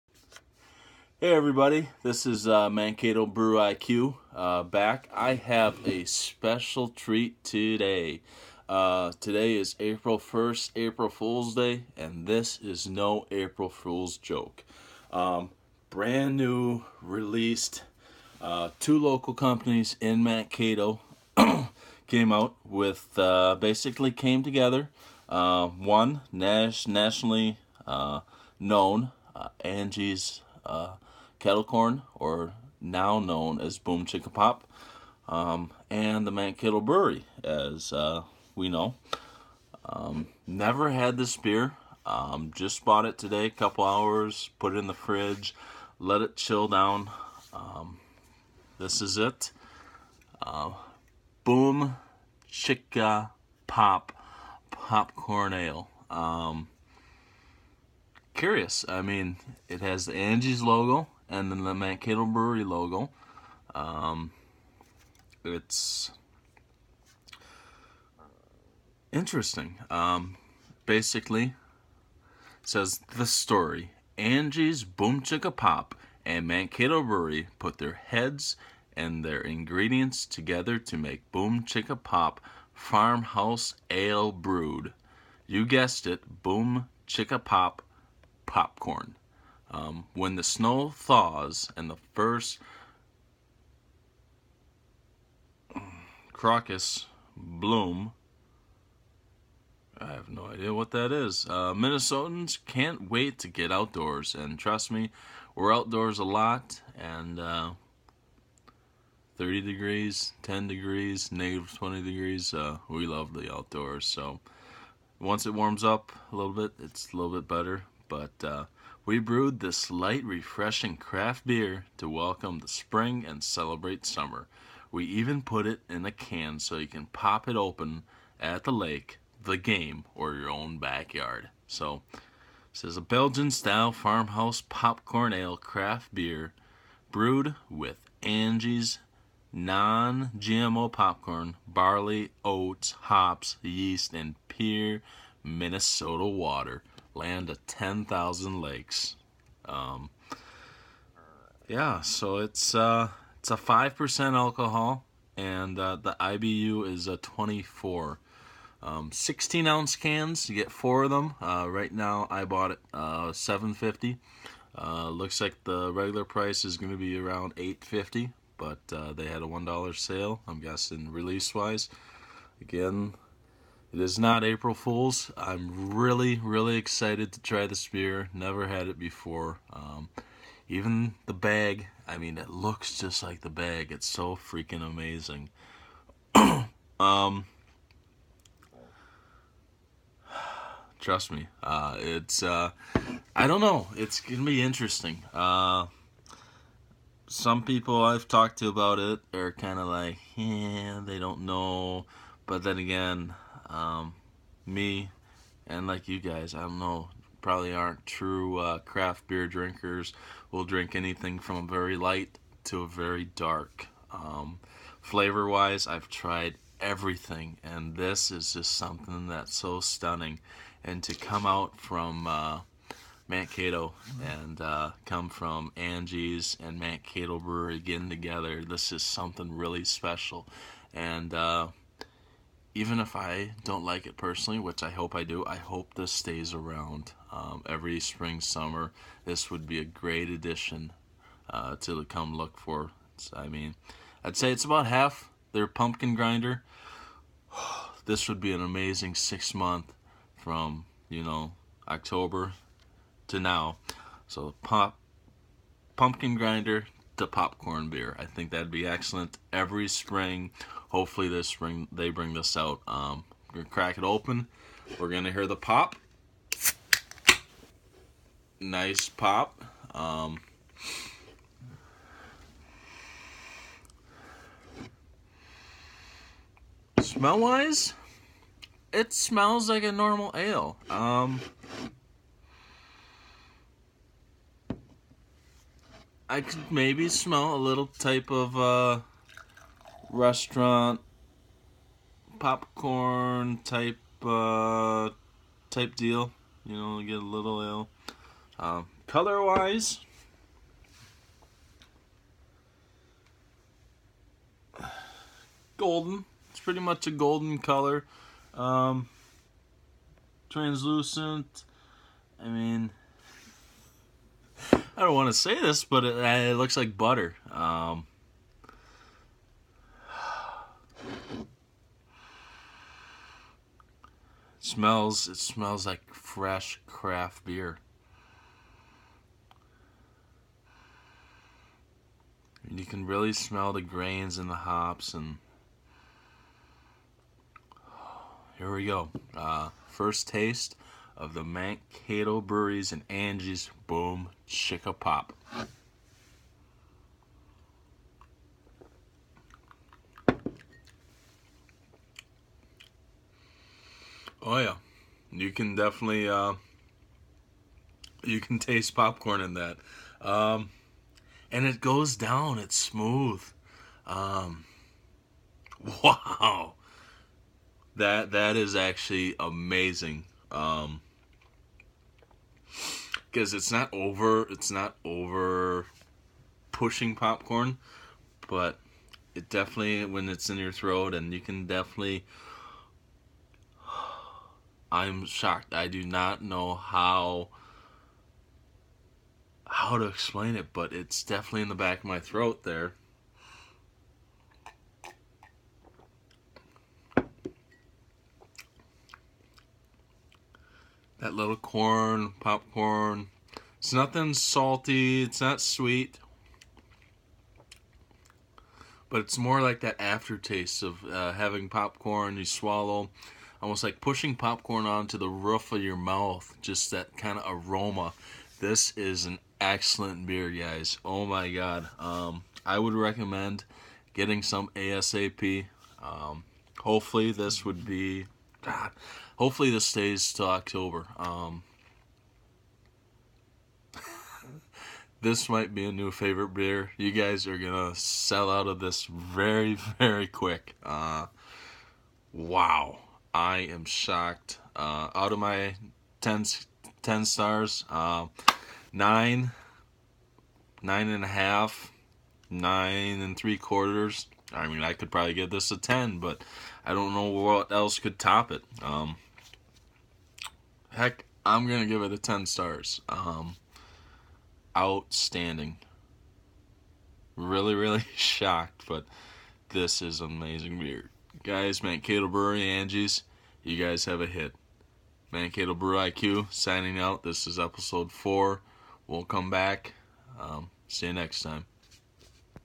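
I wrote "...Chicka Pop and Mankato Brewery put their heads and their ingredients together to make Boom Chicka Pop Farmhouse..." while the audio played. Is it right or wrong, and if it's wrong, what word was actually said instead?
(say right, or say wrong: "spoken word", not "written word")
right.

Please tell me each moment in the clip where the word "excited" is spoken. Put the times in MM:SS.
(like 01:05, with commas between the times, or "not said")
02:56.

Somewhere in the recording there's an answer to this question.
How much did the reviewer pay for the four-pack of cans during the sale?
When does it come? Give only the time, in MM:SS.
02:43.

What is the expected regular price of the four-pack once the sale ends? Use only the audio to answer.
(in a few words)
$8.50.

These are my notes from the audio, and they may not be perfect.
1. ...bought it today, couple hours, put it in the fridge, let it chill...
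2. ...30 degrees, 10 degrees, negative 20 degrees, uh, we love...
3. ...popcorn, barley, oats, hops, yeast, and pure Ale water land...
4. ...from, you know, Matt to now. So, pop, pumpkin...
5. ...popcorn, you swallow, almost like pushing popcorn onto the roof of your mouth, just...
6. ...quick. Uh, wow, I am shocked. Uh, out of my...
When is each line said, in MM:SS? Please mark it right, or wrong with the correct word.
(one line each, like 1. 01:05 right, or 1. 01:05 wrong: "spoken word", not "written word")
1. 00:42 right
2. 01:49 right
3. 02:20 wrong: "Minnesota", not "Ale"
4. 04:10 wrong: "October", not "Matt"
5. 06:51 right
6. 07:20 right.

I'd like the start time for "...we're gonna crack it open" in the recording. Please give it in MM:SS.
04:23.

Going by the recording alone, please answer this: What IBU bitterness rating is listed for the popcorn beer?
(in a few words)
24.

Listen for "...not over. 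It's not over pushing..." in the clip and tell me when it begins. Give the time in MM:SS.
06:13.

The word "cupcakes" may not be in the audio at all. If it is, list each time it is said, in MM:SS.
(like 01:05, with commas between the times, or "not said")
not said.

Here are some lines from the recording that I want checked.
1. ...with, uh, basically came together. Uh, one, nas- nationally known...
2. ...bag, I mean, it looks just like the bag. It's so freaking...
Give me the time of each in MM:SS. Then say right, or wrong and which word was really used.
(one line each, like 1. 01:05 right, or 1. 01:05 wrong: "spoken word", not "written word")
1. 00:22 right
2. 03:01 right.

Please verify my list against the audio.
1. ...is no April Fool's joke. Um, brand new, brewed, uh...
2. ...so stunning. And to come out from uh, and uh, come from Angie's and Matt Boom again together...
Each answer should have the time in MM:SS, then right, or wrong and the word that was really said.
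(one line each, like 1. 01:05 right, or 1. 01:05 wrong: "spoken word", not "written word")
1. 00:12 wrong: "released", not "brewed"
2. 03:39 wrong: "Brewery", not "Boom".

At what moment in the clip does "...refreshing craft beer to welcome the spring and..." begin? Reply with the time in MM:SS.
02:00.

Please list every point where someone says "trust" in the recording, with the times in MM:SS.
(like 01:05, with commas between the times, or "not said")
01:44, 03:11.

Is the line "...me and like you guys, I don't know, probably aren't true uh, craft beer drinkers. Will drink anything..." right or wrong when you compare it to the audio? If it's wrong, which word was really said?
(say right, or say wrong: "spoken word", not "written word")
right.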